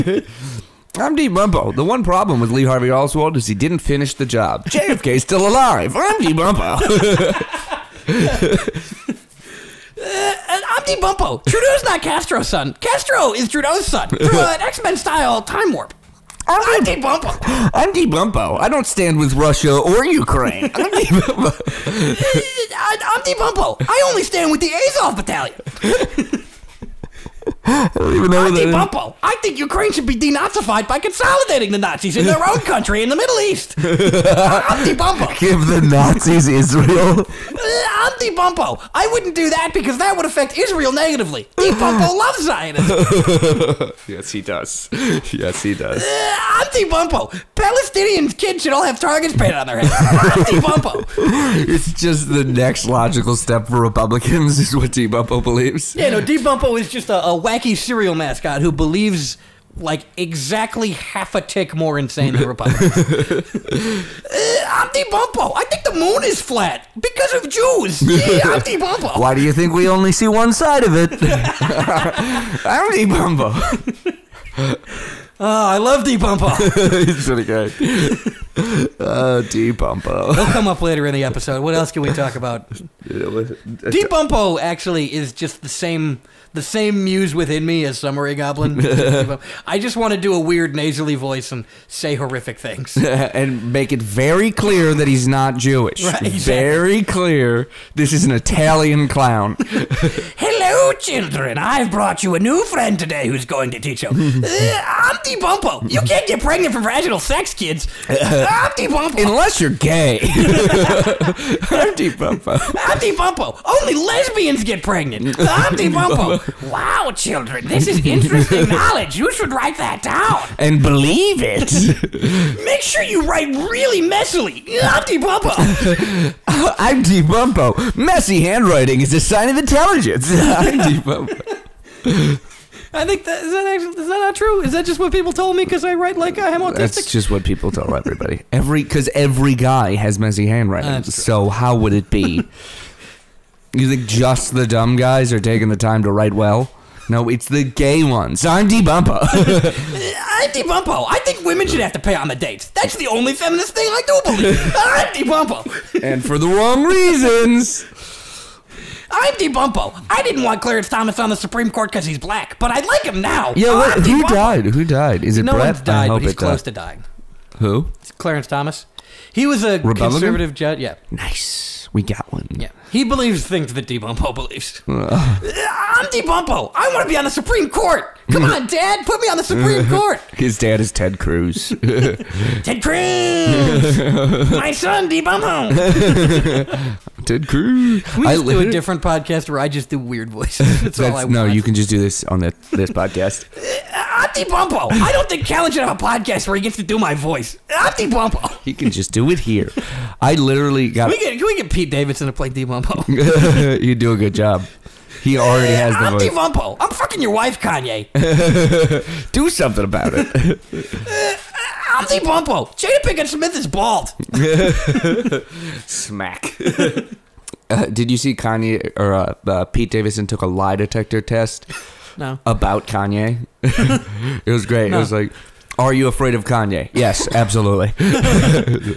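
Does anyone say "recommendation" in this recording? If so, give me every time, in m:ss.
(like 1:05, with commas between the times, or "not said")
not said.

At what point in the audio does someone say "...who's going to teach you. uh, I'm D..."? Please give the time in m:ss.
1:43.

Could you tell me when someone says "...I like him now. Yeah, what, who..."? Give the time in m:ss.
2:42.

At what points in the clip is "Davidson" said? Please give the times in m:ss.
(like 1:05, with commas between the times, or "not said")
3:21, 3:39.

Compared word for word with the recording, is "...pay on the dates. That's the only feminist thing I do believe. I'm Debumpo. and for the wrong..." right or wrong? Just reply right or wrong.
right.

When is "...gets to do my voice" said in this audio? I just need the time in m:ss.
3:16.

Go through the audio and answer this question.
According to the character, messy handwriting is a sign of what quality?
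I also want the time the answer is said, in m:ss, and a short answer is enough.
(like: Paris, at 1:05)
Intelligence, at 2:09.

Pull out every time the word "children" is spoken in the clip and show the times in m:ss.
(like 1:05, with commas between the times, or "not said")
1:40, 1:57.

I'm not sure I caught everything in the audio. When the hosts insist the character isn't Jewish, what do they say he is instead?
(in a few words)
Italian clown.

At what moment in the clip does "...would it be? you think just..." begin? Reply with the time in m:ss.
2:21.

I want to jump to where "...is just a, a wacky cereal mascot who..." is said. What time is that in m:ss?
0:56.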